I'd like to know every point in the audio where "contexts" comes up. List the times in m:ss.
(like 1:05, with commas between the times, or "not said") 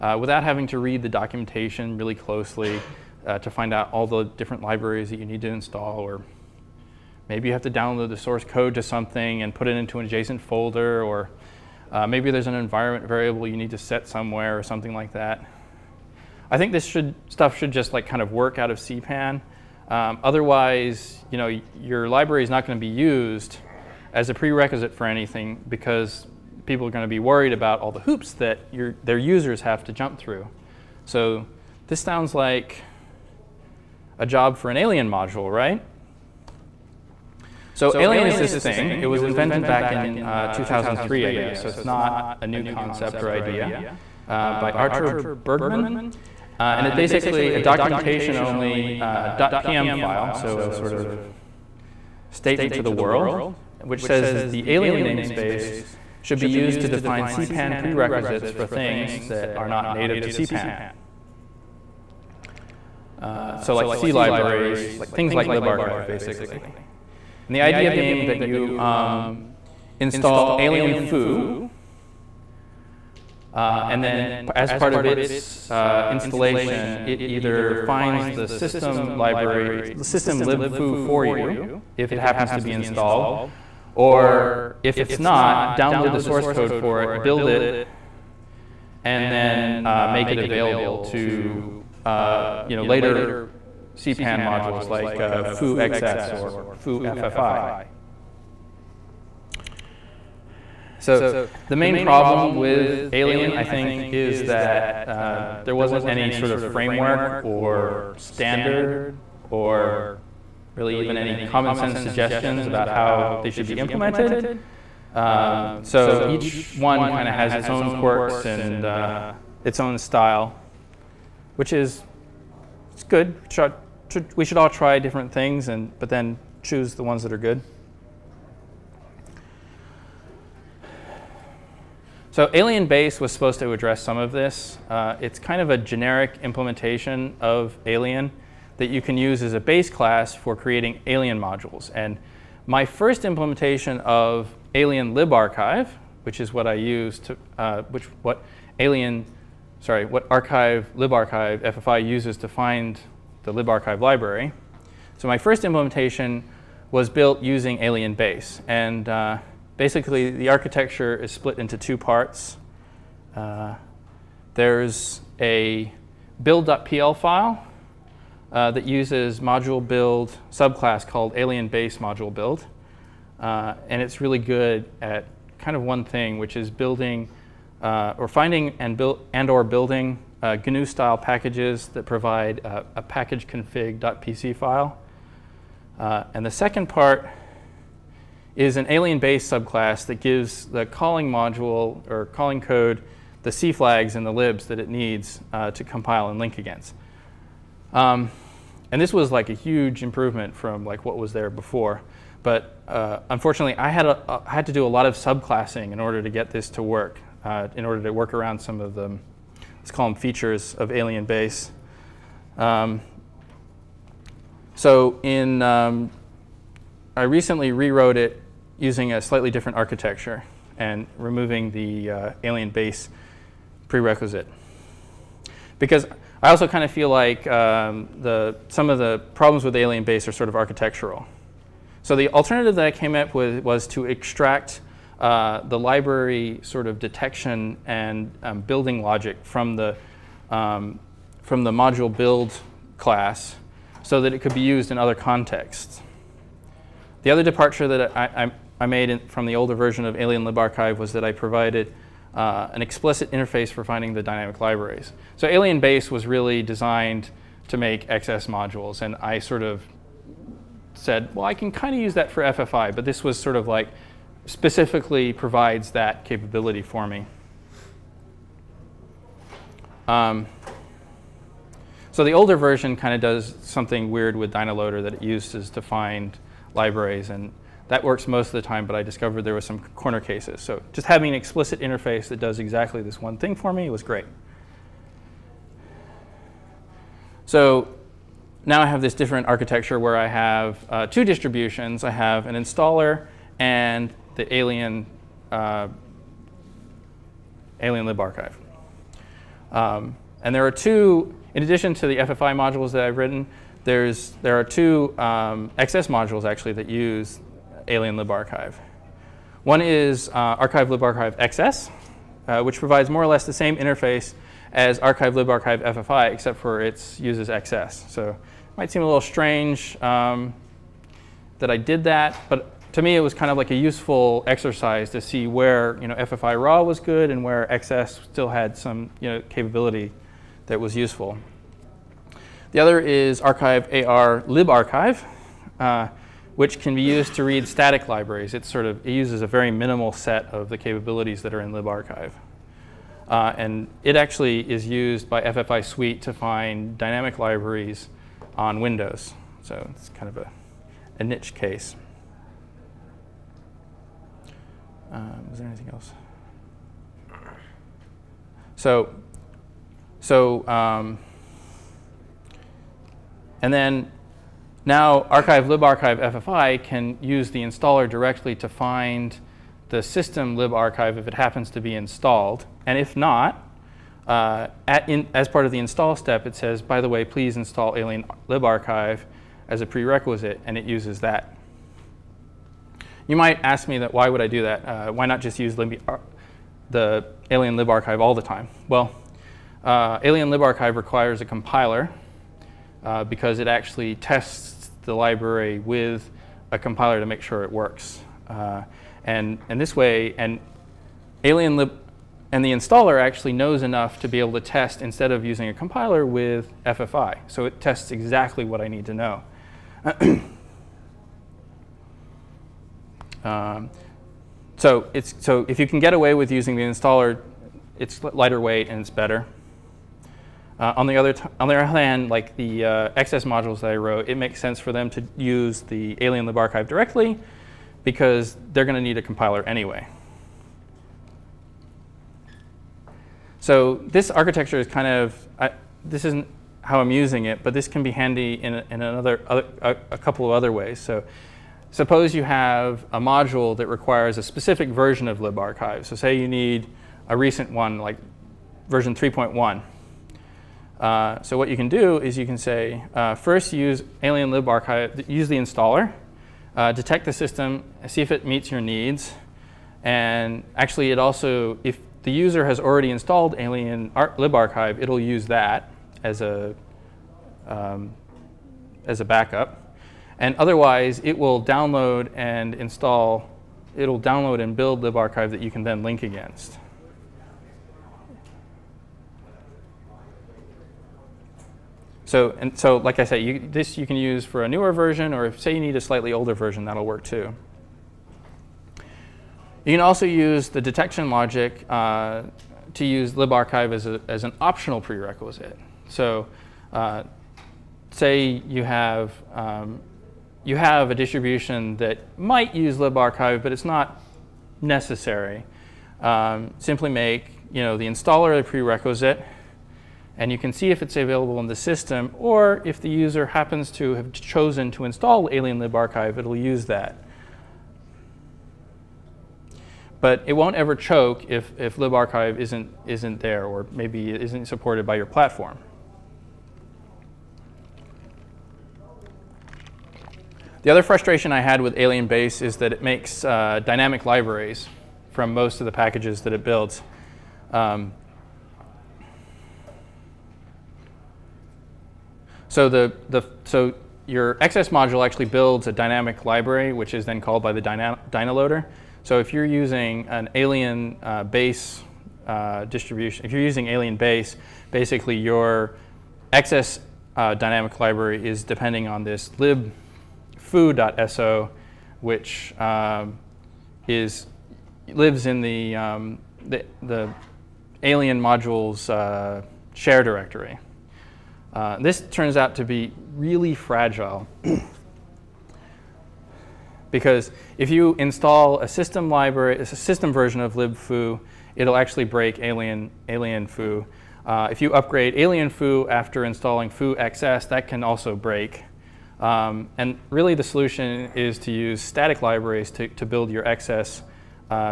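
4:05.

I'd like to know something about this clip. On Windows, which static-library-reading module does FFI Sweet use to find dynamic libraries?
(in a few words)
Archive AR libarchive.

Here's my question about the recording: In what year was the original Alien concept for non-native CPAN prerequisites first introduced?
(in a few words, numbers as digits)
2003.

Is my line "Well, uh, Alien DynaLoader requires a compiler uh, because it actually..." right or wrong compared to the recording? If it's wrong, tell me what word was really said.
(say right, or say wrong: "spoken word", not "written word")
wrong: "LibArchive", not "DynaLoader".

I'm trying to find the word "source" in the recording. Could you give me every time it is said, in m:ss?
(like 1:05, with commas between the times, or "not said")
0:08, 1:26.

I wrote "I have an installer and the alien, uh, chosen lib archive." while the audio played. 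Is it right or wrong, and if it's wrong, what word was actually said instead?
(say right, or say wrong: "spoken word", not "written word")
wrong: "alien", not "chosen".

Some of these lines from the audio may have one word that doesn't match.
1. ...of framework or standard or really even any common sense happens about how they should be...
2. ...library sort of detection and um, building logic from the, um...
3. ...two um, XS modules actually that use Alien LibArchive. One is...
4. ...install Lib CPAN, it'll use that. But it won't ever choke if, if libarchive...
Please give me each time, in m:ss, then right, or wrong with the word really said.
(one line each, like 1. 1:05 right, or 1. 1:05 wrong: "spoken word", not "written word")
1. 1:46 wrong: "suggestions", not "happens"
2. 3:55 right
3. 5:04 right
4. 8:35 wrong: "Archive", not "CPAN".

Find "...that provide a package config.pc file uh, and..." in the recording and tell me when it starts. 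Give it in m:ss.
3:01.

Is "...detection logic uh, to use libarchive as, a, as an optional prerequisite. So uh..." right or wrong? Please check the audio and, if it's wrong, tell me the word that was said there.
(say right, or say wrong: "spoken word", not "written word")
right.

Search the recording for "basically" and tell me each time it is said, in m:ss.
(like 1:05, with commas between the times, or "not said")
0:46, 1:06, 2:39, 9:14.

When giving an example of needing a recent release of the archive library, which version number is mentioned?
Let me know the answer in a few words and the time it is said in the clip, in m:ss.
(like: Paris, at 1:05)
3.1, at 7:28.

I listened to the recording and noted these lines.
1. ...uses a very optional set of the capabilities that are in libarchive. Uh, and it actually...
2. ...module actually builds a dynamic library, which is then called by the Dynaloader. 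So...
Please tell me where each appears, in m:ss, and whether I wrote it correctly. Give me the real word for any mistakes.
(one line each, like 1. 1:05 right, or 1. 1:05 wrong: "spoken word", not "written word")
1. 5:39 wrong: "minimal", not "optional"
2. 9:04 right.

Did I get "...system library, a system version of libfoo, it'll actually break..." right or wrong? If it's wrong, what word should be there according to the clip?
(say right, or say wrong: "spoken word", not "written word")
right.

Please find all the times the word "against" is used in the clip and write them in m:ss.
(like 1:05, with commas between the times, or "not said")
3:16, 7:56.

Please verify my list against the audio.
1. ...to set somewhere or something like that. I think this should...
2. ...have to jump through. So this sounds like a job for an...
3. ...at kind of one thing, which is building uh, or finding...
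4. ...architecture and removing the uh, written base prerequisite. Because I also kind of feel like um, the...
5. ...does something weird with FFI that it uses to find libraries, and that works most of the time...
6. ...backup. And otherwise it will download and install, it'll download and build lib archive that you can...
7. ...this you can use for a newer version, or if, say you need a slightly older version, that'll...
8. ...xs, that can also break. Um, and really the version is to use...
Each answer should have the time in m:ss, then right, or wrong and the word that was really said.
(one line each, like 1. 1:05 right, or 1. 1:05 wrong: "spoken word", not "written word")
1. 0:13 right
2. 0:29 right
3. 2:55 right
4. 3:39 wrong: "alien", not "written"
5. 4:33 wrong: "DynaLoader", not "FFI"
6. 7:49 right
7. 8:03 right
8. 9:47 wrong: "solution", not "version".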